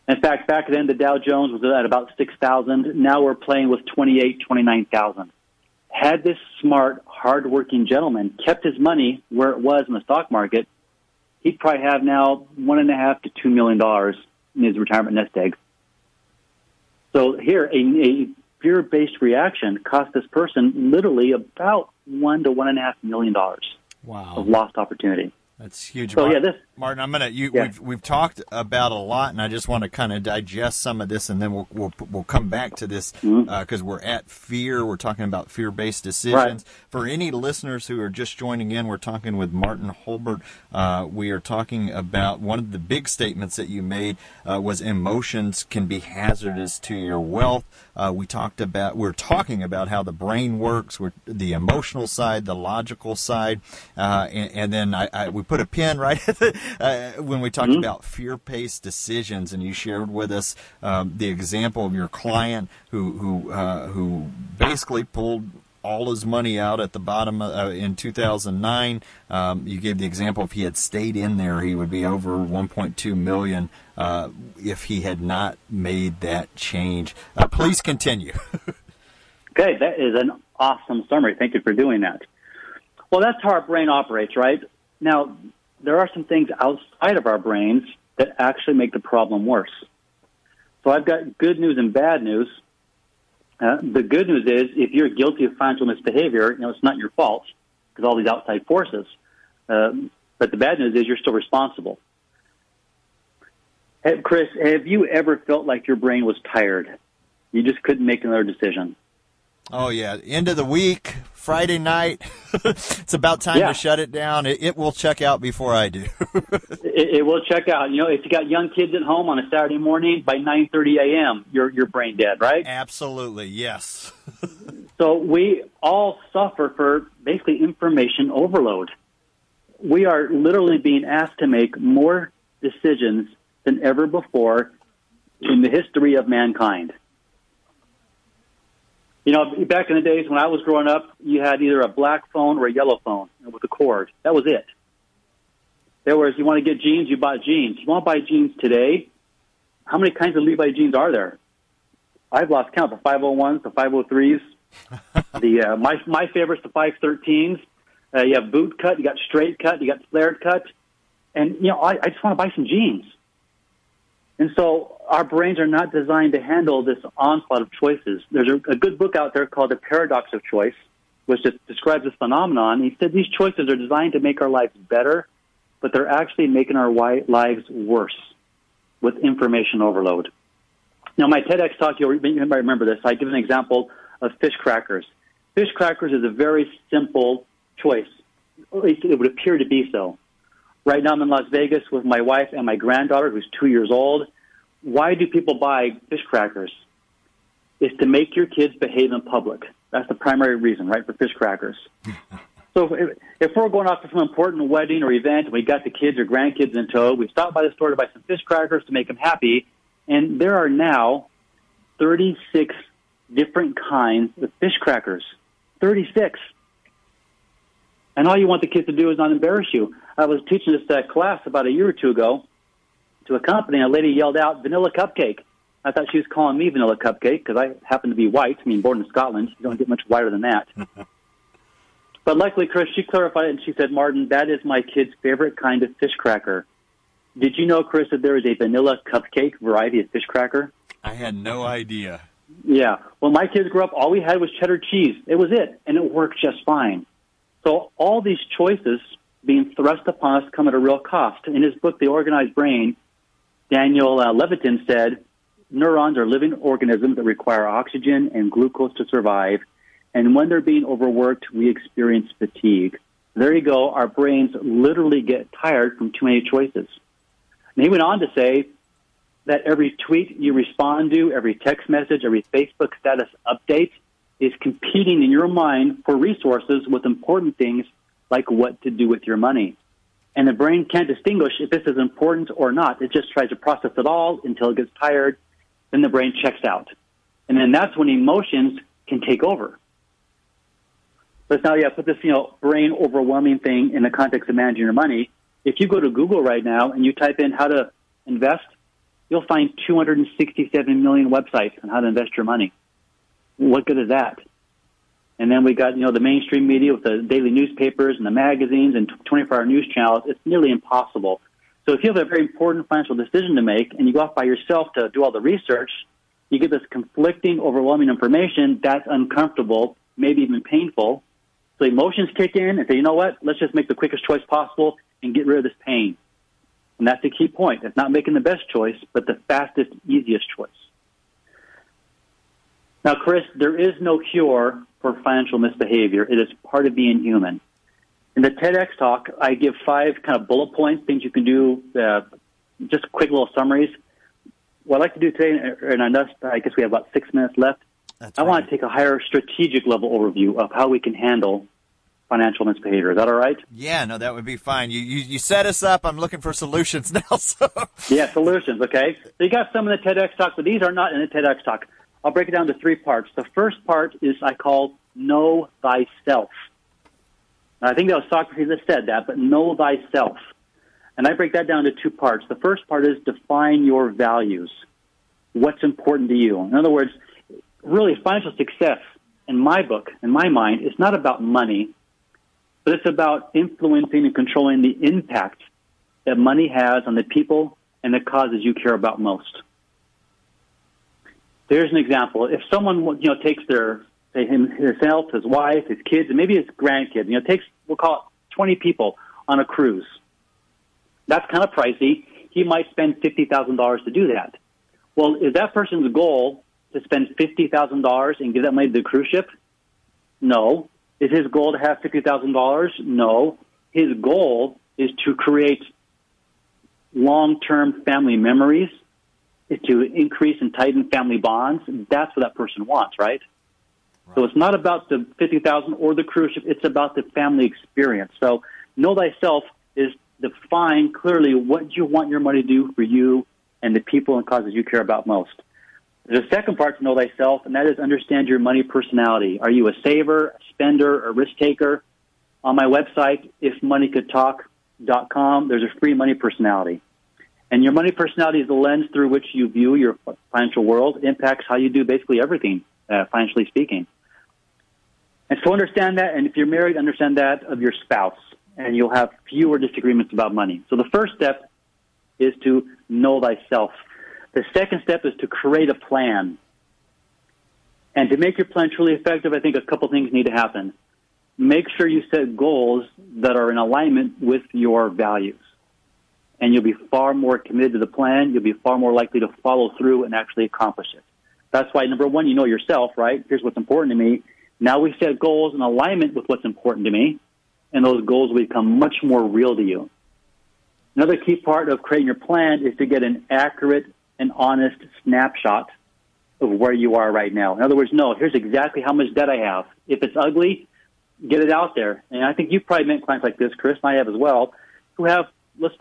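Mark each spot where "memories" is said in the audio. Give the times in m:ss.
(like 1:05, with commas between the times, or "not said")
6:58.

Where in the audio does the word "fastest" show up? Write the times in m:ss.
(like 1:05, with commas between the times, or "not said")
5:29.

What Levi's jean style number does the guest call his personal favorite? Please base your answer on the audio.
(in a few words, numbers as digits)
513s.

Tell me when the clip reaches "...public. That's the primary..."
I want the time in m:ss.
3:19.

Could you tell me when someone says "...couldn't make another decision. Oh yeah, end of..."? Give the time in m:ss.
1:47.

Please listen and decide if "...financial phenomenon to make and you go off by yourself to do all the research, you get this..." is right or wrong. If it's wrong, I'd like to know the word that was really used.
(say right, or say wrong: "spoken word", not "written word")
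wrong: "decision", not "phenomenon".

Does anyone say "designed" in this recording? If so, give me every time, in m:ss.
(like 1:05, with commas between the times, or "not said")
2:45, 2:53.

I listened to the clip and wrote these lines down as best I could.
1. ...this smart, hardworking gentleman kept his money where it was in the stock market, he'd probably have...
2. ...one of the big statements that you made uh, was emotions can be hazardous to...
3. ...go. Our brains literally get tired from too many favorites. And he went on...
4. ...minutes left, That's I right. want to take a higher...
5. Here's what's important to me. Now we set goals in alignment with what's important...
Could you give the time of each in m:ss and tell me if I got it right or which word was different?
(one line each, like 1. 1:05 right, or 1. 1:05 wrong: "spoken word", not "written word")
1. 0:06 right
2. 0:42 right
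3. 4:23 wrong: "choices", not "favorites"
4. 5:47 right
5. 8:03 right.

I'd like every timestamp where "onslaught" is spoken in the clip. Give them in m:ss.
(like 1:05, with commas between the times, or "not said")
2:47.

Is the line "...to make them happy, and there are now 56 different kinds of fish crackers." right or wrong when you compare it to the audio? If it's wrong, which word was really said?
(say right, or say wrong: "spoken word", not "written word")
wrong: "36", not "56".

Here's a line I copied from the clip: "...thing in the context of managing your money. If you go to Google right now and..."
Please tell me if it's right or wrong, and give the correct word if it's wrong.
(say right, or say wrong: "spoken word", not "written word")
right.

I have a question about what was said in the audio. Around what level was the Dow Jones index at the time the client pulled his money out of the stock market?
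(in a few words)
6,000.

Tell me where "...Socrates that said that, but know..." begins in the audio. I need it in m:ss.
6:08.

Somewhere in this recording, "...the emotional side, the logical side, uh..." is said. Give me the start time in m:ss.
0:51.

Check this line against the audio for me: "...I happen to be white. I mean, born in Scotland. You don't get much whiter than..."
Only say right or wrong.
right.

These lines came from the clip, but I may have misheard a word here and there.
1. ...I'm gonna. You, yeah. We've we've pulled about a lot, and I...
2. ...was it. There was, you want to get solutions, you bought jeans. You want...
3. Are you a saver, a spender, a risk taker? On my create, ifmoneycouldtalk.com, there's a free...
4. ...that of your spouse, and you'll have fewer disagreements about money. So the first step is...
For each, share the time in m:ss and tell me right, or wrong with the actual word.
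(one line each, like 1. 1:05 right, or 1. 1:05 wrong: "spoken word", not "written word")
1. 0:27 wrong: "talked", not "pulled"
2. 2:24 wrong: "jeans", not "solutions"
3. 7:19 wrong: "website", not "create"
4. 7:37 right.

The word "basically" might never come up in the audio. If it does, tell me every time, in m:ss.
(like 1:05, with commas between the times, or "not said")
1:04, 2:07, 7:32.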